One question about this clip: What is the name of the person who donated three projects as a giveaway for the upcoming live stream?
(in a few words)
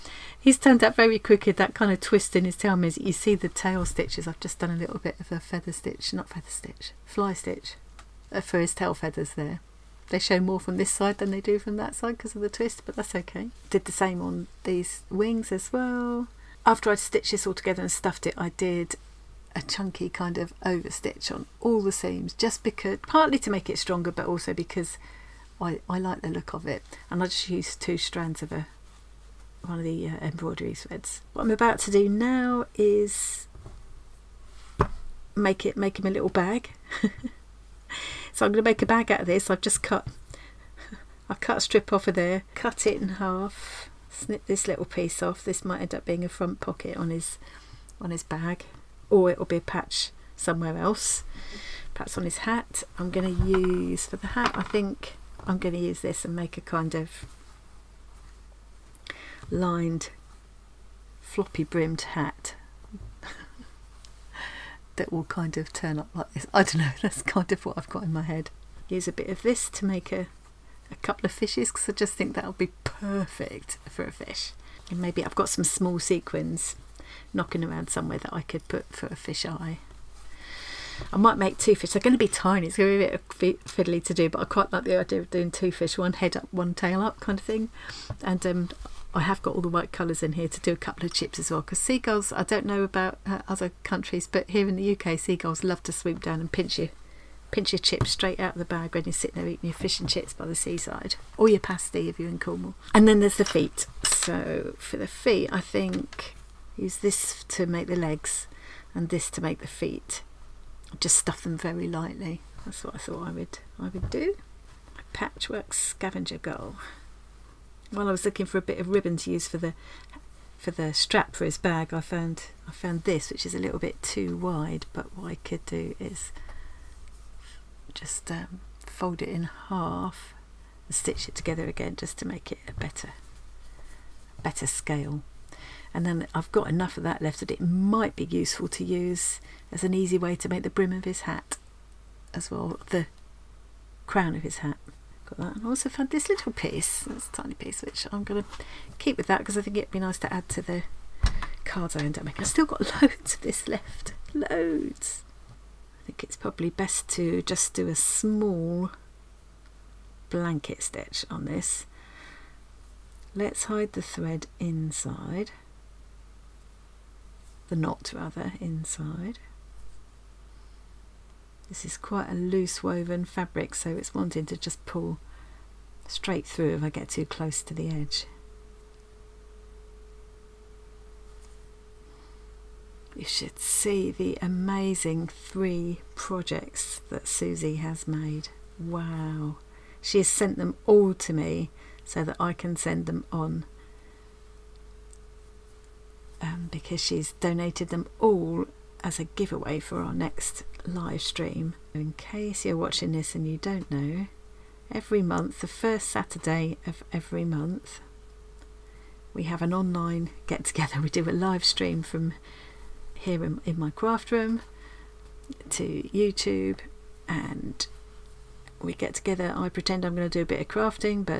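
Suzie.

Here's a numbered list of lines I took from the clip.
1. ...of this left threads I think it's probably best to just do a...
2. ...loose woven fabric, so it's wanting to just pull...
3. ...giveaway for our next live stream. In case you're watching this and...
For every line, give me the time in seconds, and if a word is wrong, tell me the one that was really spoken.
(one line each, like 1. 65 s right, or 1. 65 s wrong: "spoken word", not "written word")
1. 153 s wrong: "loads", not "threads"
2. 172 s right
3. 199 s right.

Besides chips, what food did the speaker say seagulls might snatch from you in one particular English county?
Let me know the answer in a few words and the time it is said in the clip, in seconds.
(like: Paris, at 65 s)
pasty, at 101 s.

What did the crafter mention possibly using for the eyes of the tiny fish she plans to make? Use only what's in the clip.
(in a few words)
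sequins.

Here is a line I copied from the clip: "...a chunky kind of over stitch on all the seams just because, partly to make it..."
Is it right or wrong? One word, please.
right.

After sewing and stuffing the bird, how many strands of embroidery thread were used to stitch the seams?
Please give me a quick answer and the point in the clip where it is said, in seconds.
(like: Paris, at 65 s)
2, at 27 s.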